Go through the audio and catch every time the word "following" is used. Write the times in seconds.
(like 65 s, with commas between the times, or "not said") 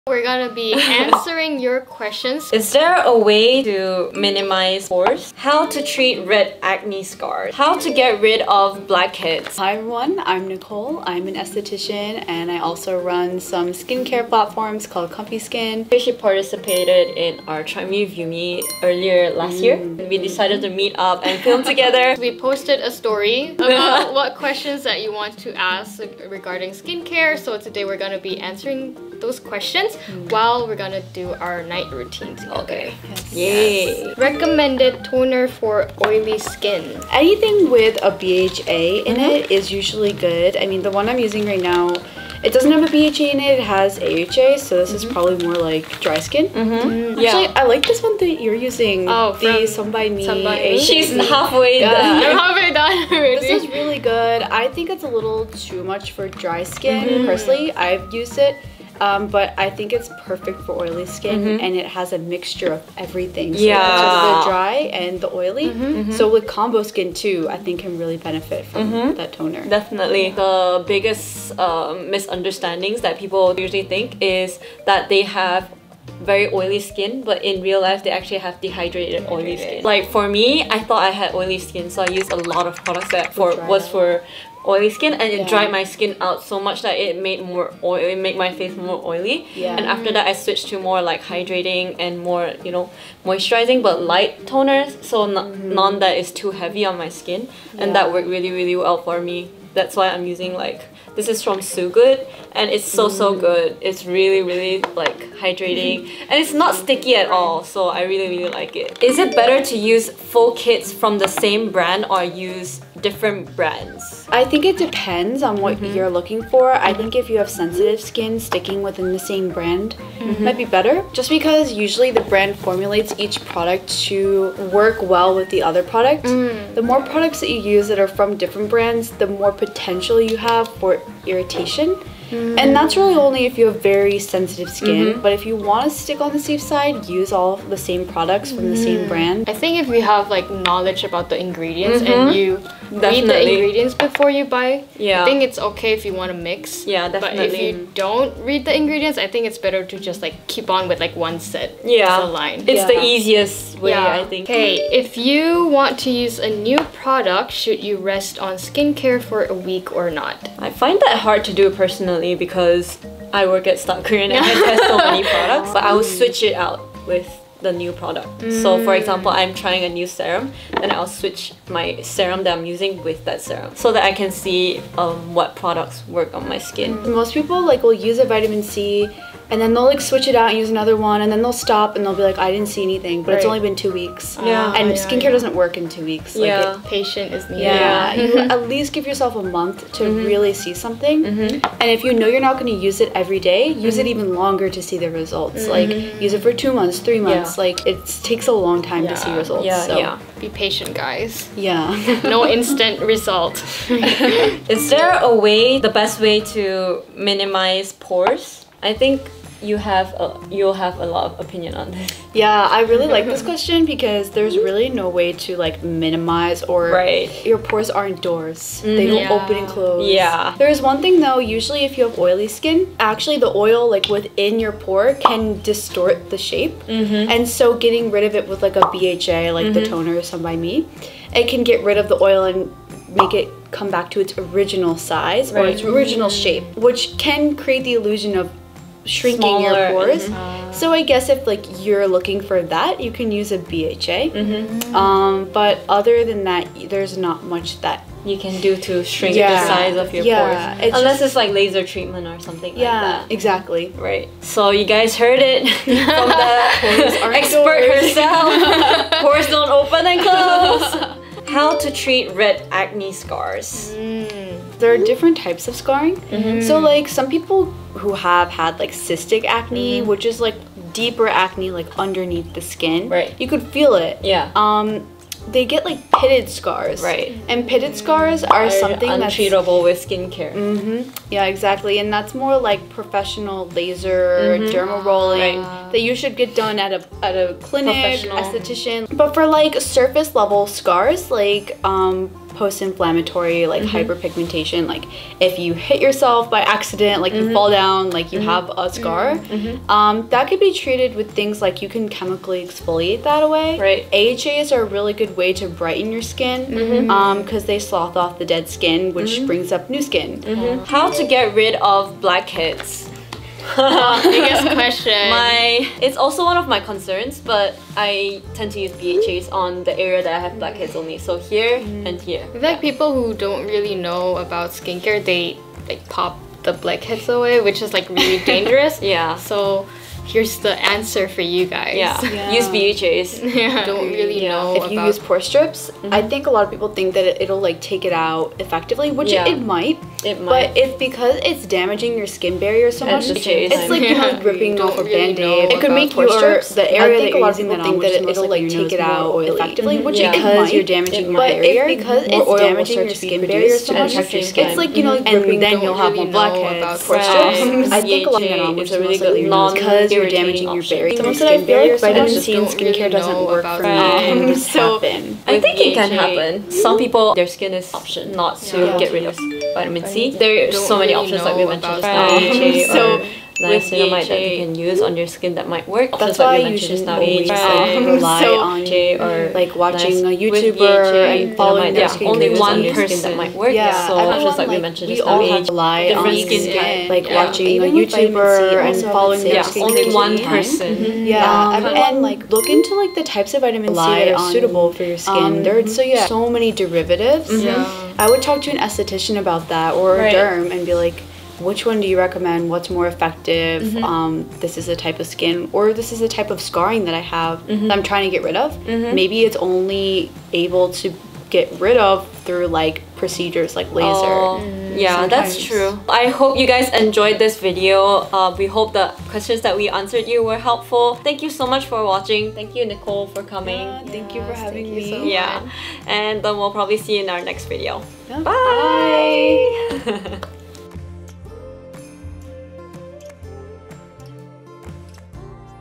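381 s, 389 s.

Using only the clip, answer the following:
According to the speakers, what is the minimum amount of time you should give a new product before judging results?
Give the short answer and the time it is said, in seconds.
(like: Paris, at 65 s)
a month, at 189 s.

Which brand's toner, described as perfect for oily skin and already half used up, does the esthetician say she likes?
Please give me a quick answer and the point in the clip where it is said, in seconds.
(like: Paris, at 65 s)
Some By Mi, at 49 s.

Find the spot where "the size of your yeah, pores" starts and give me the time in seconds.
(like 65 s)
249 s.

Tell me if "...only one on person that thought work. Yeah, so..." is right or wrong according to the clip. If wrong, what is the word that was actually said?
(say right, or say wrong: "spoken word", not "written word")
wrong: "might", not "thought".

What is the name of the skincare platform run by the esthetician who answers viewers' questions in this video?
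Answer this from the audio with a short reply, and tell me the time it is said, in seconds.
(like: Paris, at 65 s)
Comfy Skin, at 15 s.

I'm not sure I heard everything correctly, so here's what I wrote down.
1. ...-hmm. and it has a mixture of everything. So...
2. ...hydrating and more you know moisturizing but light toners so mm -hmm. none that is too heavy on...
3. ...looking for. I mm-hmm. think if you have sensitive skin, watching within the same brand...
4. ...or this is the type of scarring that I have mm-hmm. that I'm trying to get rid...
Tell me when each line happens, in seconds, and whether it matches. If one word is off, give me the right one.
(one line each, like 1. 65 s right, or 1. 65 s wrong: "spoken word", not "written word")
1. 61 s right
2. 91 s right
3. 116 s wrong: "sticking", not "watching"
4. 405 s right.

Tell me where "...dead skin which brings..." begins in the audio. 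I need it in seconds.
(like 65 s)
308 s.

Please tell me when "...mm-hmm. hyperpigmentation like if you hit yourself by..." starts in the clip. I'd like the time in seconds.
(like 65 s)
293 s.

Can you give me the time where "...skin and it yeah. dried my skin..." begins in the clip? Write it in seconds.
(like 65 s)
84 s.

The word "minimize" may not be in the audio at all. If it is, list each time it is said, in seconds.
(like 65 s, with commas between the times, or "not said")
4 s, 207 s, 215 s.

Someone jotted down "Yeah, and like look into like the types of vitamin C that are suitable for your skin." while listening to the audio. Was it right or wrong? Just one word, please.
right.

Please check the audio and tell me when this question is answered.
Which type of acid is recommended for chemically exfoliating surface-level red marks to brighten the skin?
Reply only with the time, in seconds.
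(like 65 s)
304 s.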